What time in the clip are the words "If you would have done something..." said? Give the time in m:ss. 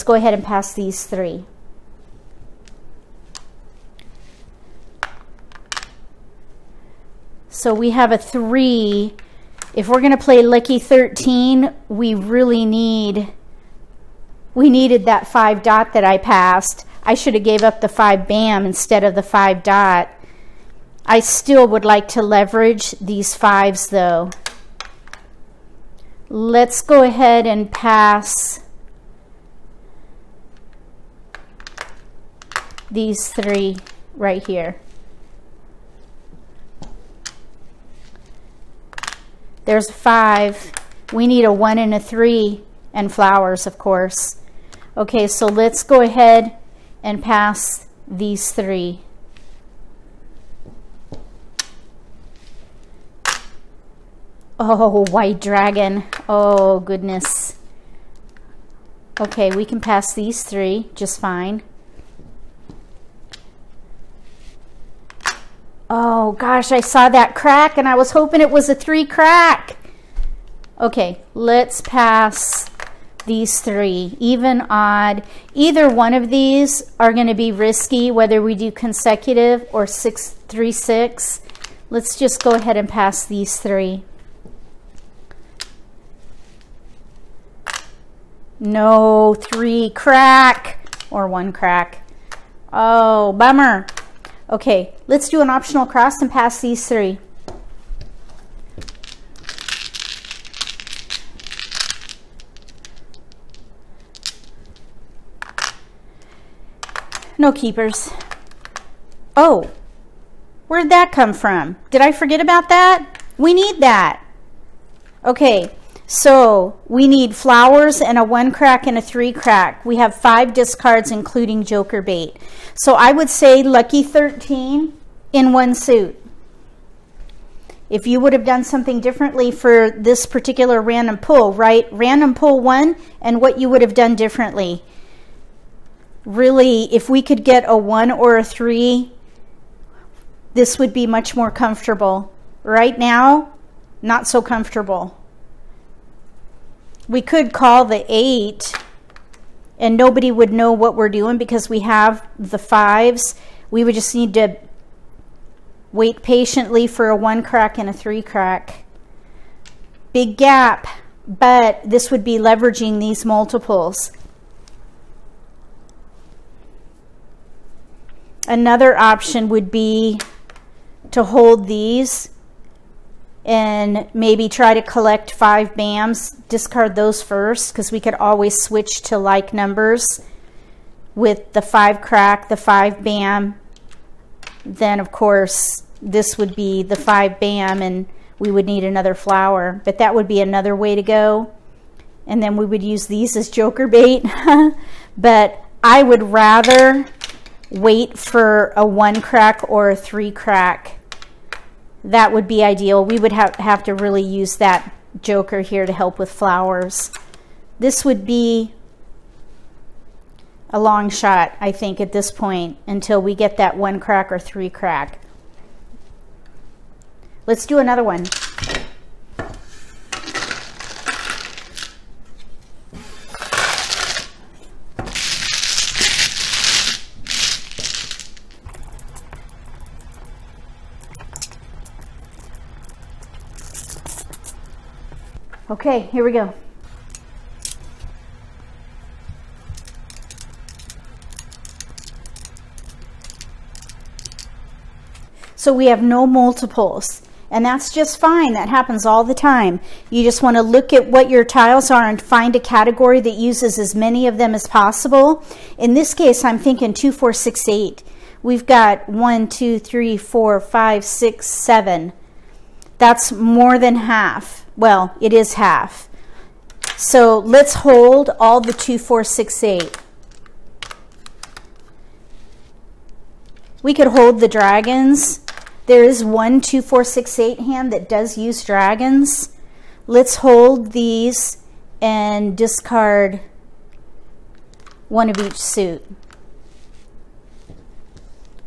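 2:07.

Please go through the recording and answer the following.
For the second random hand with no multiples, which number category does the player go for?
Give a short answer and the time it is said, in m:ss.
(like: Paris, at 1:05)
2, 4, 6, 8, at 4:16.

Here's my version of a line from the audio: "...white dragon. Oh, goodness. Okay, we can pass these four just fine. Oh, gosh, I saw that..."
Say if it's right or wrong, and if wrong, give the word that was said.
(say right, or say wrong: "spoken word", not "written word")
wrong: "three", not "four".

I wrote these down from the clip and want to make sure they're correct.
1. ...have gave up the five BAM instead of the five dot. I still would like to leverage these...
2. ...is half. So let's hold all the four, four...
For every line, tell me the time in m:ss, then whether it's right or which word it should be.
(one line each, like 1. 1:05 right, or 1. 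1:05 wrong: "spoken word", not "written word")
1. 0:17 right
2. 4:25 wrong: "two", not "four".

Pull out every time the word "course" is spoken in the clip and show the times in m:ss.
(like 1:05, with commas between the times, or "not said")
0:43, 3:05.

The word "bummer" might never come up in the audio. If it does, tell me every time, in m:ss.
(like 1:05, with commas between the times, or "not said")
1:33.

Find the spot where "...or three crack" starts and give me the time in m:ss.
3:34.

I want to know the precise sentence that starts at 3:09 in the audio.
But that would be another way to go.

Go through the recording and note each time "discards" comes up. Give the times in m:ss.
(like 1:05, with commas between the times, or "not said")
2:00, 2:56, 4:42.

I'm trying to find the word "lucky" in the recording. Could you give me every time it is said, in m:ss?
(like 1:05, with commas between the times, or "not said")
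0:10, 2:03.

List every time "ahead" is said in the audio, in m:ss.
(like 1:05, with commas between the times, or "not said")
0:00, 0:27, 0:46, 1:22.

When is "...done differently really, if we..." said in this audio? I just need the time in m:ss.
2:13.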